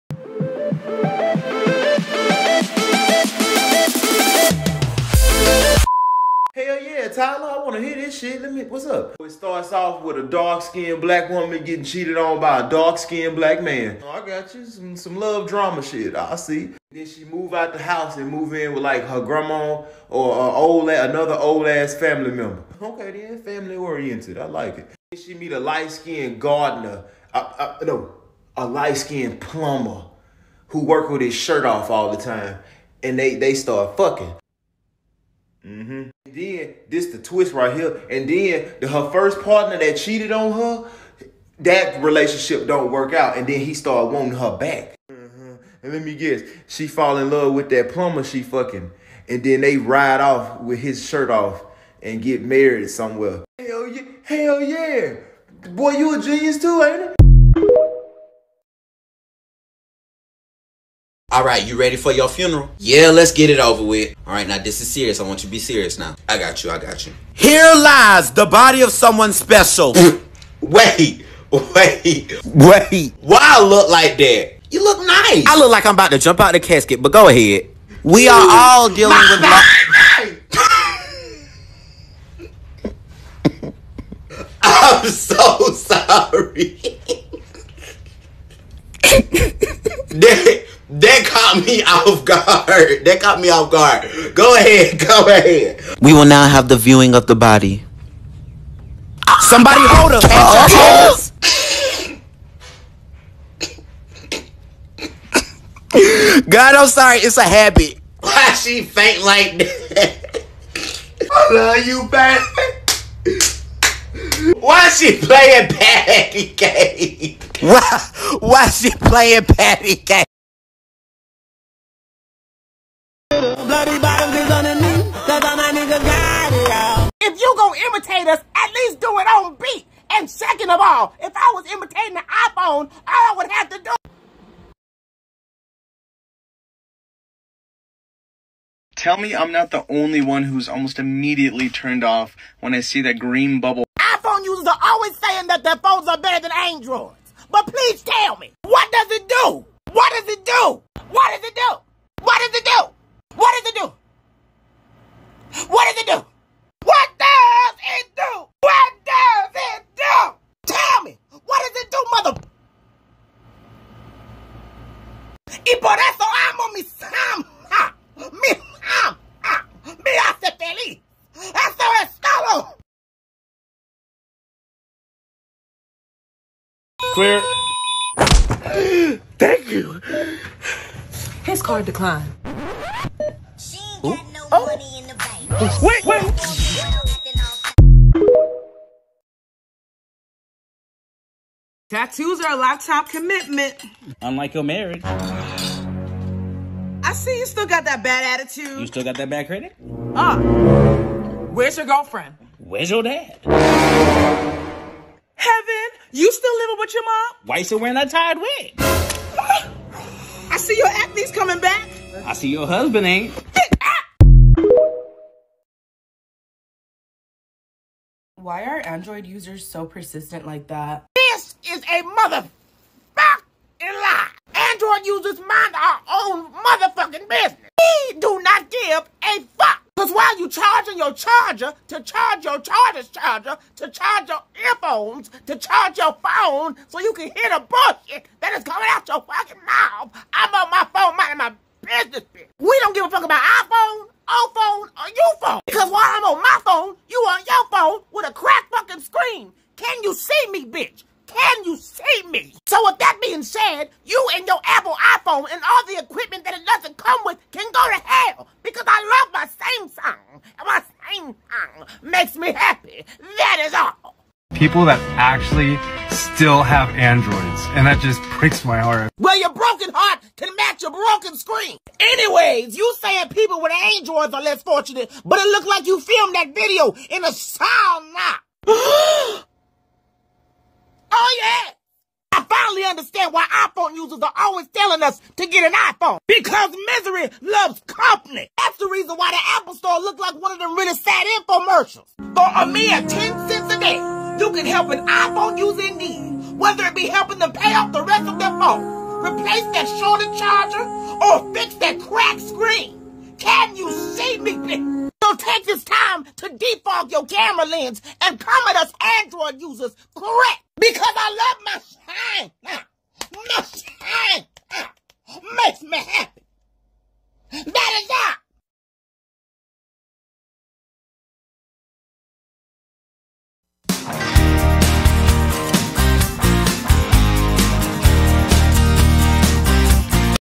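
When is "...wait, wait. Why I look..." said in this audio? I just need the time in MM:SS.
01:11.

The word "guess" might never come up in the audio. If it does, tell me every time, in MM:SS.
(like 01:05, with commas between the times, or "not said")
00:46.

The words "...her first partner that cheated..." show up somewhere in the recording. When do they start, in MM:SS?
00:38.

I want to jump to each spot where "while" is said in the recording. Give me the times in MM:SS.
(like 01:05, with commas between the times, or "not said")
03:50, 04:05.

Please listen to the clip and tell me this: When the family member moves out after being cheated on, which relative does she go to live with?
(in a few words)
Her grandma.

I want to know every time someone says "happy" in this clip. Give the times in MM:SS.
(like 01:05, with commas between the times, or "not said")
04:22, 05:15.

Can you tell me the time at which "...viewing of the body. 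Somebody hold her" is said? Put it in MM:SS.
01:36.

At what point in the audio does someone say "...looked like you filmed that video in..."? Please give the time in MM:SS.
04:35.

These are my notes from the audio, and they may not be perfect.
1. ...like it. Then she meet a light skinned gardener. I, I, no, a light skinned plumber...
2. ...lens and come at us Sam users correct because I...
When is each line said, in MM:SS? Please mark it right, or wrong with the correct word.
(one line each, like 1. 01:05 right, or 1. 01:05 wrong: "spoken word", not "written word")
1. 00:24 right
2. 05:07 wrong: "Android", not "Sam".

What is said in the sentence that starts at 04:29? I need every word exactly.
Well, your broken heart can match your broken screen.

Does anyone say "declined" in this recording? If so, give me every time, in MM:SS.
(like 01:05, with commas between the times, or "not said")
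03:01.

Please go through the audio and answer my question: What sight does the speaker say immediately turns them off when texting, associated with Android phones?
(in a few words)
Green bubble.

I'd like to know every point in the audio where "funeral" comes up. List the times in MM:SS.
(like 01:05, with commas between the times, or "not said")
01:02.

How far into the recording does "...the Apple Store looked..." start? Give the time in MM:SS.
04:49.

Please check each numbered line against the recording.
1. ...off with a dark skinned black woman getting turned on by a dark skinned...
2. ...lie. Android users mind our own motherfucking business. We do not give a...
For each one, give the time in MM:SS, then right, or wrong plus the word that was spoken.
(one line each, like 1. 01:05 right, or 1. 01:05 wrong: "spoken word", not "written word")
1. 00:09 wrong: "cheated", not "turned"
2. 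03:43 right.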